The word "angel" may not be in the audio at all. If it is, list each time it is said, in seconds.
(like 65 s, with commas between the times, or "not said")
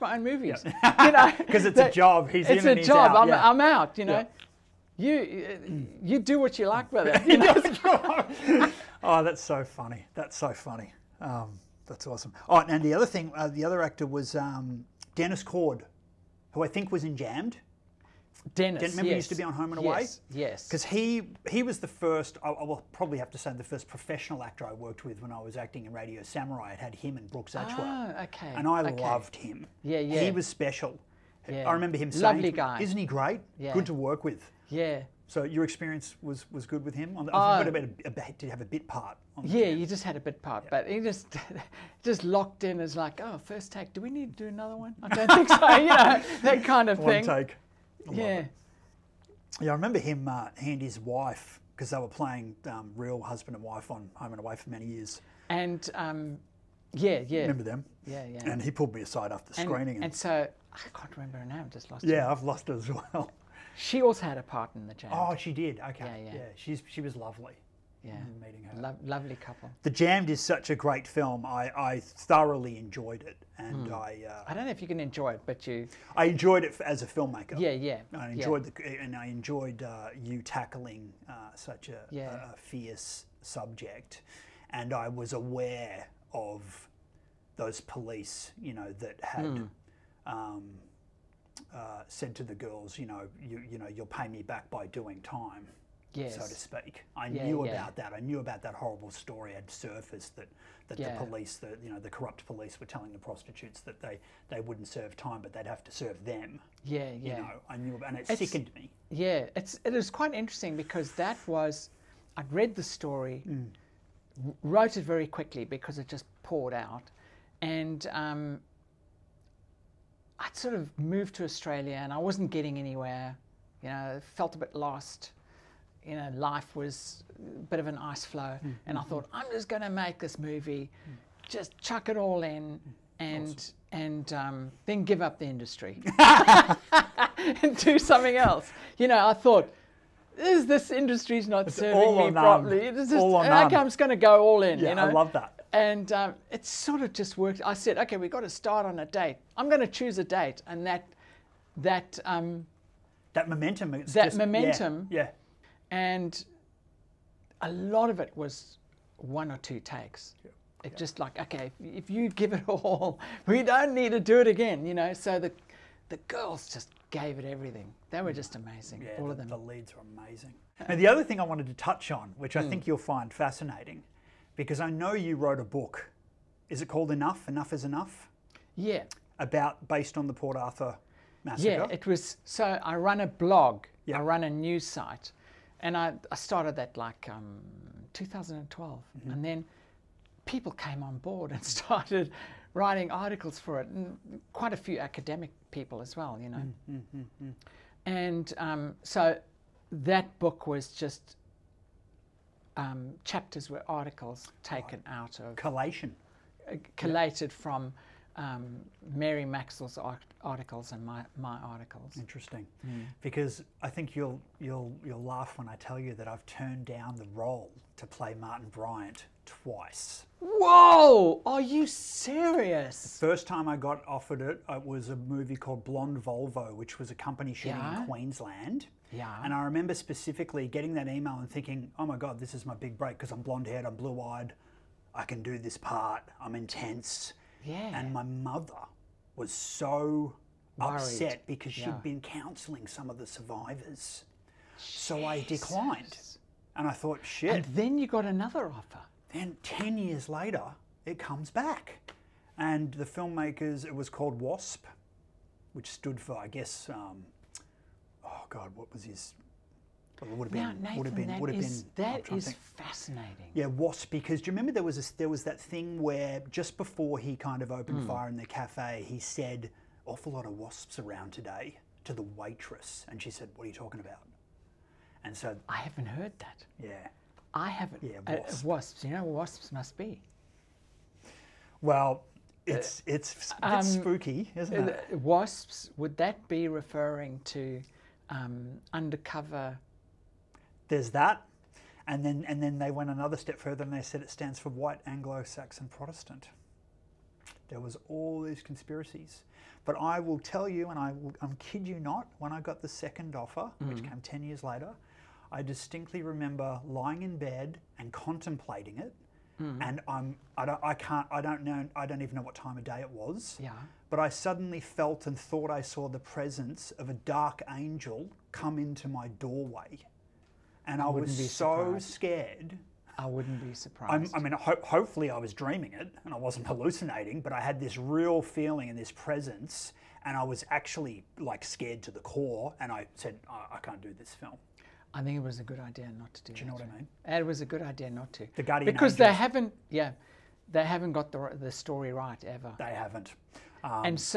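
317 s, 339 s.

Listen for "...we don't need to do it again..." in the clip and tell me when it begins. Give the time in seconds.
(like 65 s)
163 s.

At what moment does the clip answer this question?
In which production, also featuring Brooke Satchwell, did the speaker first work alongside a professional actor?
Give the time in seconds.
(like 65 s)
25 s.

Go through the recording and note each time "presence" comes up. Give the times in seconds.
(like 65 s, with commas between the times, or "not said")
316 s, 329 s.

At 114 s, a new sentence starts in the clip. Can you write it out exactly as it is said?
wrote it very quickly because it just poured out, and.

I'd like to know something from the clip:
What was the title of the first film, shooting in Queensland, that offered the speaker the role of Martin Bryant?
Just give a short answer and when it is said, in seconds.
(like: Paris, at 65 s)
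Blonde Volvo, at 225 s.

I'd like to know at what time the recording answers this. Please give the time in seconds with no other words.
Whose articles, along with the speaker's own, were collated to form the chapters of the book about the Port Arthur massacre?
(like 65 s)
209 s.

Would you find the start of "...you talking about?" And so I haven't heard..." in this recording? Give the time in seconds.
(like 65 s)
273 s.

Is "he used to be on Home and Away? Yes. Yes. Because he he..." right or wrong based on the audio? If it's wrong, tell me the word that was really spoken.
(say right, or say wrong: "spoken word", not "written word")
right.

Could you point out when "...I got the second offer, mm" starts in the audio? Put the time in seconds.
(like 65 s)
302 s.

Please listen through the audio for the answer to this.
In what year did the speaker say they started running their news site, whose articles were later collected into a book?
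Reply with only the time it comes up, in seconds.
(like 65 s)
188 s.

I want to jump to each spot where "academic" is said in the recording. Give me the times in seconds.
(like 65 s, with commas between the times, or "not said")
194 s.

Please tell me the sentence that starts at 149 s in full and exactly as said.
I'm going to choose a date, and that that um, that momentum.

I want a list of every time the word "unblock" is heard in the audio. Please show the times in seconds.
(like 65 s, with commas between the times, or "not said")
not said.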